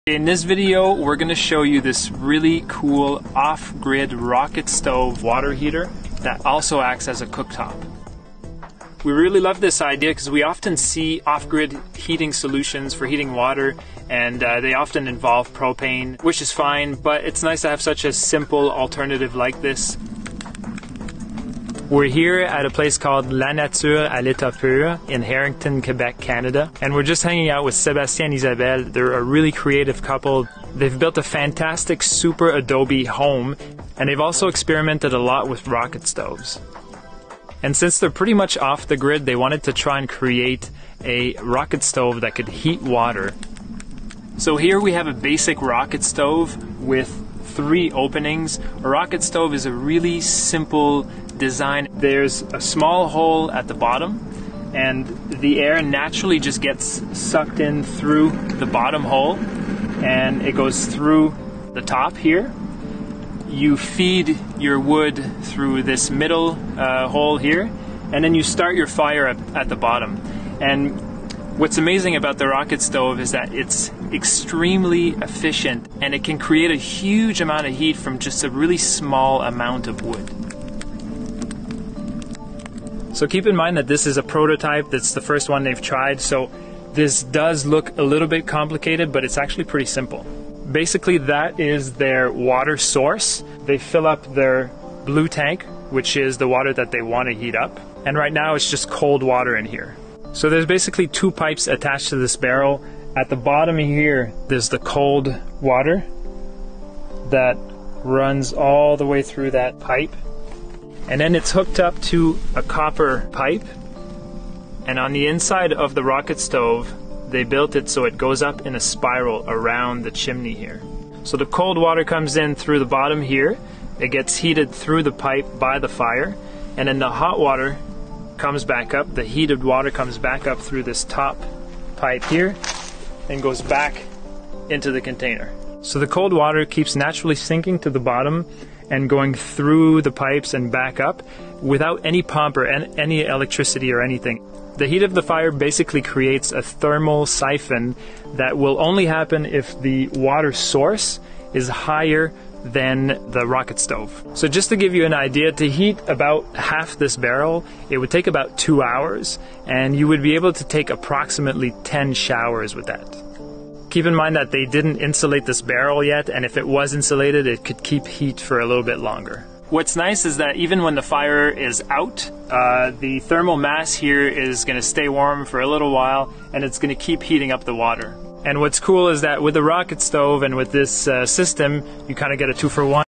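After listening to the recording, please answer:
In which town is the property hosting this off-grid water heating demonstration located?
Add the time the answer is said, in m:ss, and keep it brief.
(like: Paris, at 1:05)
Harrington, at 0:25.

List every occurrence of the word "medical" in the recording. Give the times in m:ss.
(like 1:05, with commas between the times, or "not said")
not said.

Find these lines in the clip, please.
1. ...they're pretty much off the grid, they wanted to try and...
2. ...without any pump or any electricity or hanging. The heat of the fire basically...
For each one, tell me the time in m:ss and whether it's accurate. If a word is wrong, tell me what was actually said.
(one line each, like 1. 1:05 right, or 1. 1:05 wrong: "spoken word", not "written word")
1. 0:37 right
2. 2:21 wrong: "anything", not "hanging".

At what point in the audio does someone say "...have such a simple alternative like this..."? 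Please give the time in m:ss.
0:17.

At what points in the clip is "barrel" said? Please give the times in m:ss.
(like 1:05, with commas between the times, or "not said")
1:42, 2:37, 2:45.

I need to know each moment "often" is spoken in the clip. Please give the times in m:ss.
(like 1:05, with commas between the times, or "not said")
0:10, 0:14.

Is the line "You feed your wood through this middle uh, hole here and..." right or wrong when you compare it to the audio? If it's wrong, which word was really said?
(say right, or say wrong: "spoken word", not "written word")
right.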